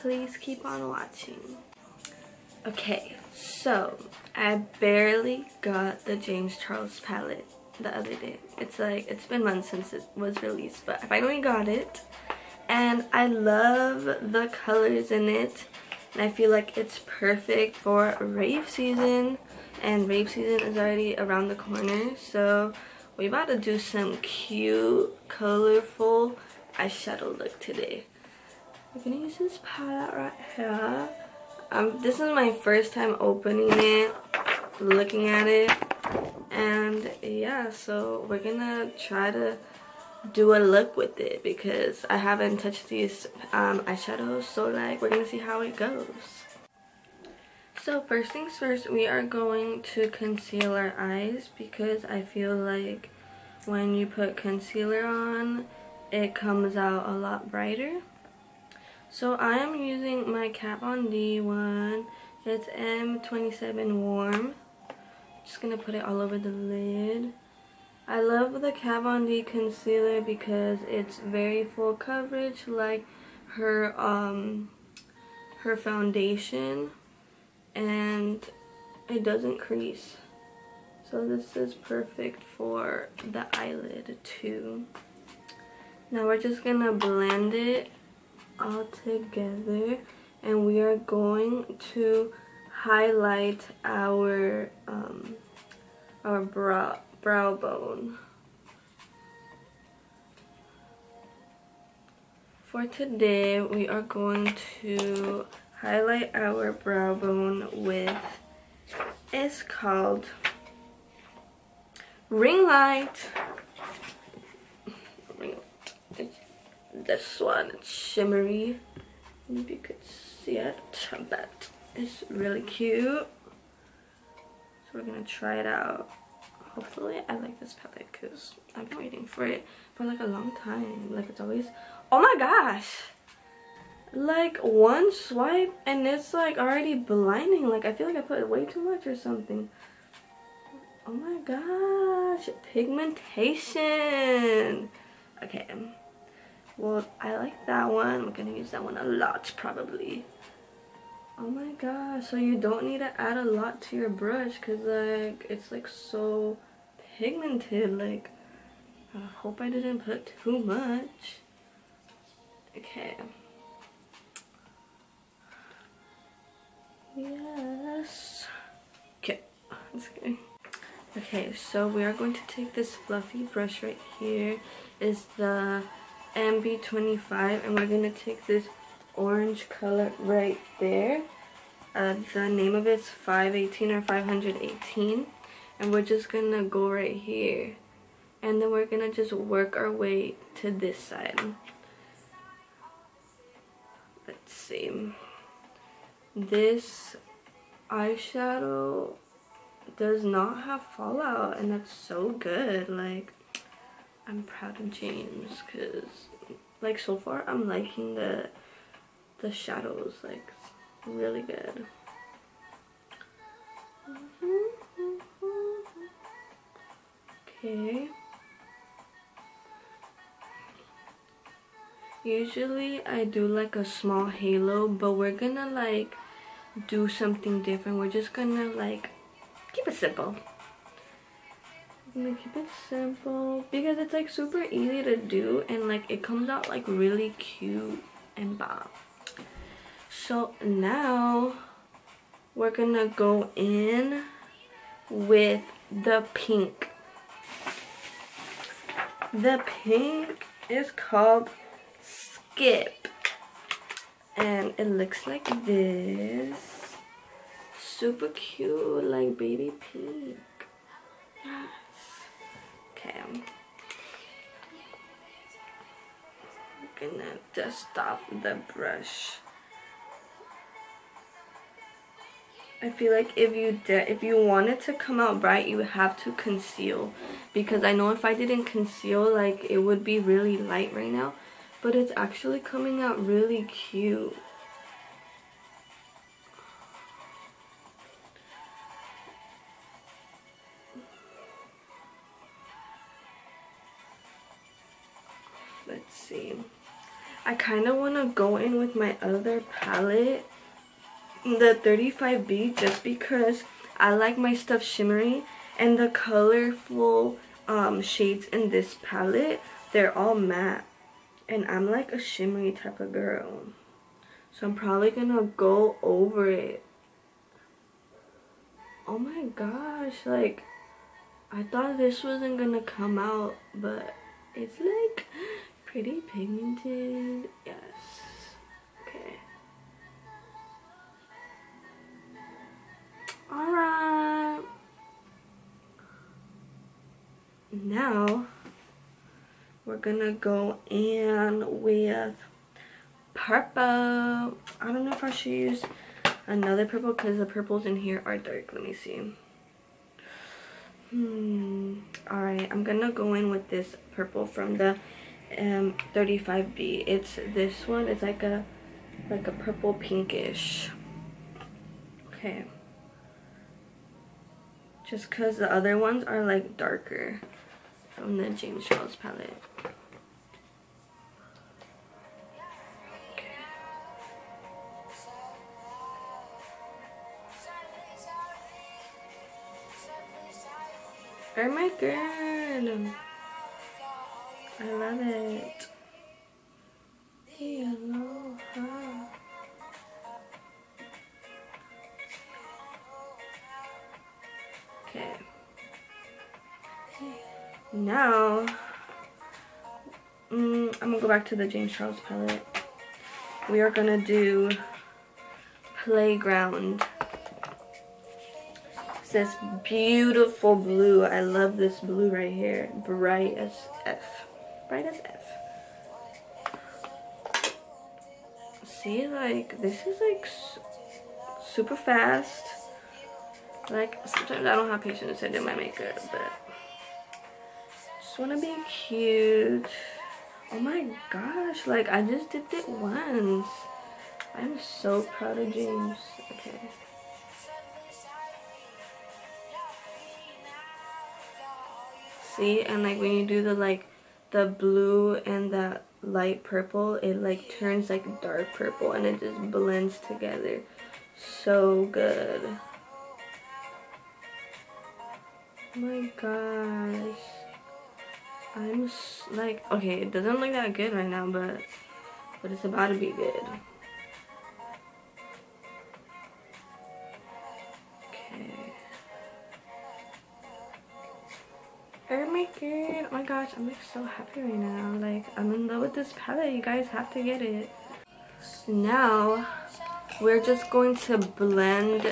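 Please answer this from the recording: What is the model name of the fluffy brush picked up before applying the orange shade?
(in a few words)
MB25.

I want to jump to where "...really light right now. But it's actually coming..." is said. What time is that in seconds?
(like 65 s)
280 s.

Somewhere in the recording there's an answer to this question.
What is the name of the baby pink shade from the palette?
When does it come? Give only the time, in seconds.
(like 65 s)
252 s.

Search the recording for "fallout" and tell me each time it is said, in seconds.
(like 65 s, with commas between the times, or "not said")
200 s.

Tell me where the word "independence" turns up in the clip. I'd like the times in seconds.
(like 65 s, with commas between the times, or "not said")
not said.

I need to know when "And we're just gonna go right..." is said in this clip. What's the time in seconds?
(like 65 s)
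185 s.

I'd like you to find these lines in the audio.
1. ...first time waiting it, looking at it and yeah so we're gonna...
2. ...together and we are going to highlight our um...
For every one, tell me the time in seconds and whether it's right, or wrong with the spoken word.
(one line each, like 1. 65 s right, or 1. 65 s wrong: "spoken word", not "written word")
1. 32 s wrong: "opening", not "waiting"
2. 88 s right.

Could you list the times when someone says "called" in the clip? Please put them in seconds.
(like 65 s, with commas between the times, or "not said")
109 s, 250 s.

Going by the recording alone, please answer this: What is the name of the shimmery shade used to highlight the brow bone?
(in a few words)
Ring Light.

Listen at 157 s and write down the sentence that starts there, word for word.
Like I hope I didn't put too much.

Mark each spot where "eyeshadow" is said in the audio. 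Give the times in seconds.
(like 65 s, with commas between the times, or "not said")
26 s, 43 s, 197 s.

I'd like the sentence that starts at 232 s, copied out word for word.
I'm gonna keep it simple because it's like super easy to do and like it comes out like really cute and bomb.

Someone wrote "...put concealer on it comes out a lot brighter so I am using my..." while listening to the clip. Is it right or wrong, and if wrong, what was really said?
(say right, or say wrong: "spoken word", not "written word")
right.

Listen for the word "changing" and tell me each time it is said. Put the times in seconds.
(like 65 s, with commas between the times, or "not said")
not said.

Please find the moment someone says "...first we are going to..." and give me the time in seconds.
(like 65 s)
48 s.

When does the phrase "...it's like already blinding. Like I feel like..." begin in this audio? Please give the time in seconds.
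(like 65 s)
136 s.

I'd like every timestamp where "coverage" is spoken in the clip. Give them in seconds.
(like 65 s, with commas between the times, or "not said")
71 s.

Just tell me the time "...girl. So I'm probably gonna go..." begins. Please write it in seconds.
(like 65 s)
313 s.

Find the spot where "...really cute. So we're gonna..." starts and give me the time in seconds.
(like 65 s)
122 s.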